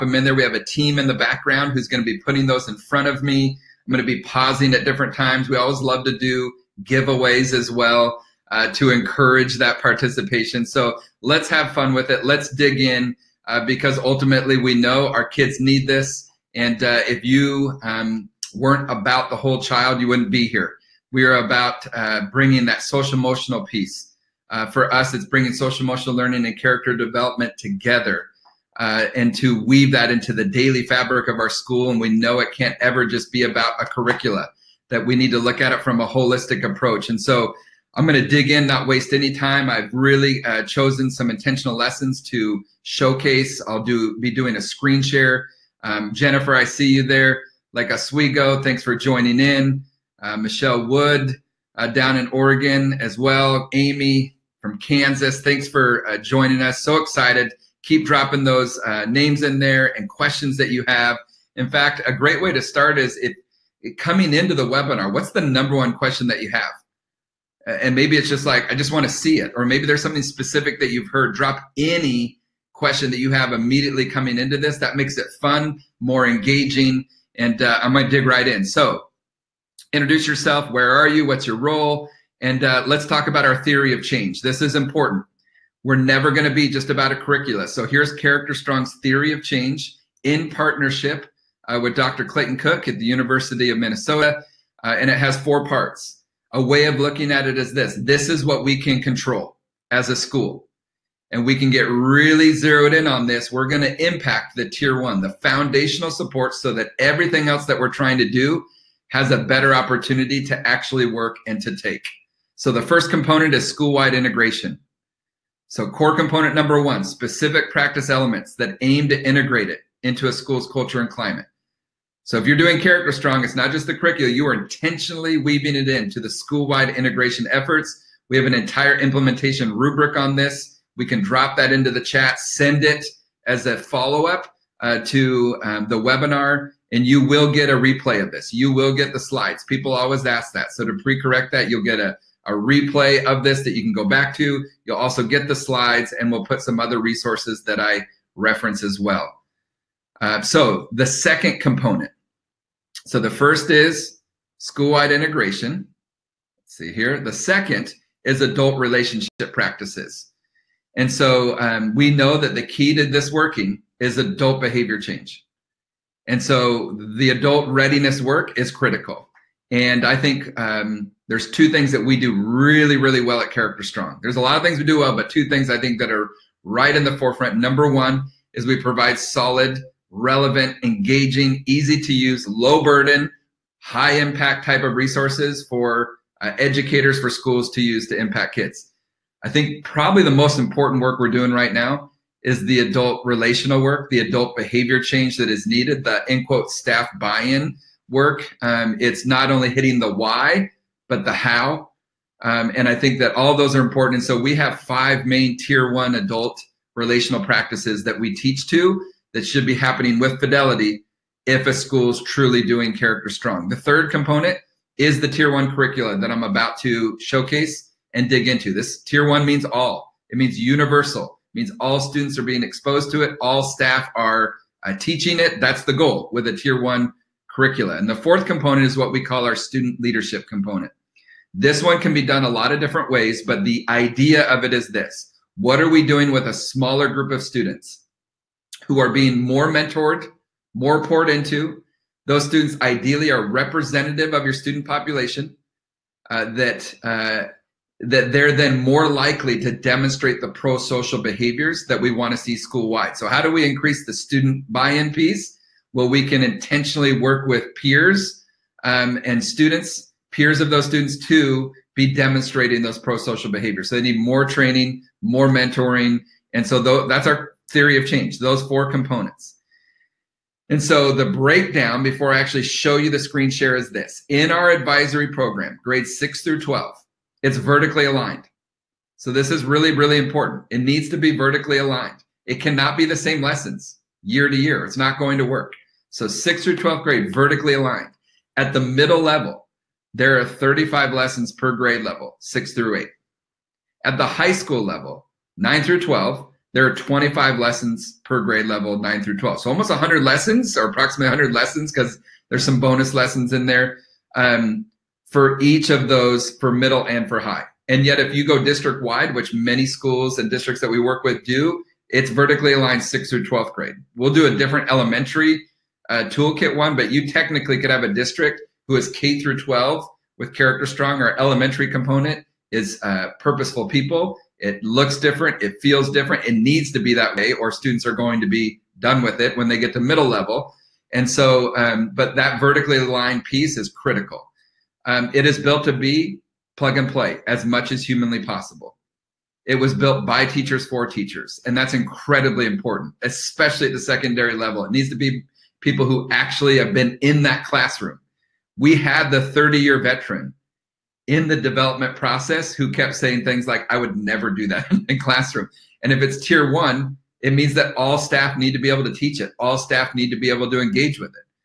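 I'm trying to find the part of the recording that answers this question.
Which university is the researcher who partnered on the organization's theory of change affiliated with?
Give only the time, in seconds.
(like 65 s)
93 s.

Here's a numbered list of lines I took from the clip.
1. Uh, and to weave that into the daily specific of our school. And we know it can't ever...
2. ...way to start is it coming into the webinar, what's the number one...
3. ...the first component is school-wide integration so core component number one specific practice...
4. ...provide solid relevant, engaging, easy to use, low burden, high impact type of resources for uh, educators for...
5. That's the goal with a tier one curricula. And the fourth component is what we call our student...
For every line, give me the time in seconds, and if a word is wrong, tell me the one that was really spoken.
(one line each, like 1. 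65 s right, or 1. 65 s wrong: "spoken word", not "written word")
1. 28 s wrong: "fabric", not "specific"
2. 62 s right
3. 112 s right
4. 178 s right
5. 225 s right.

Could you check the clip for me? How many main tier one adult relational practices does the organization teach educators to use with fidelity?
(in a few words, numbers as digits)
5.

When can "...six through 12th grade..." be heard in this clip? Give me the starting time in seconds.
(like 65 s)
286 s.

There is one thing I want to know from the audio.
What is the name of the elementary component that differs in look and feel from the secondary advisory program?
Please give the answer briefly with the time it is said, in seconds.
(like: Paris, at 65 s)
Purposeful People, at 323 s.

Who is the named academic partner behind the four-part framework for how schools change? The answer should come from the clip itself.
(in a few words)
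Dr. Clayton Cook.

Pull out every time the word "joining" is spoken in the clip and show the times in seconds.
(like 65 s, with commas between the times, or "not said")
48 s, 56 s.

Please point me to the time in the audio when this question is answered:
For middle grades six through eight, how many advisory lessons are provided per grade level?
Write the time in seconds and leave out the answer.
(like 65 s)
290 s.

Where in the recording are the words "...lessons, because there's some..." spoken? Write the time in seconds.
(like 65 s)
301 s.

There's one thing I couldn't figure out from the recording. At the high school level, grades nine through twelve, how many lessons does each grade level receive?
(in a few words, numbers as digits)
25.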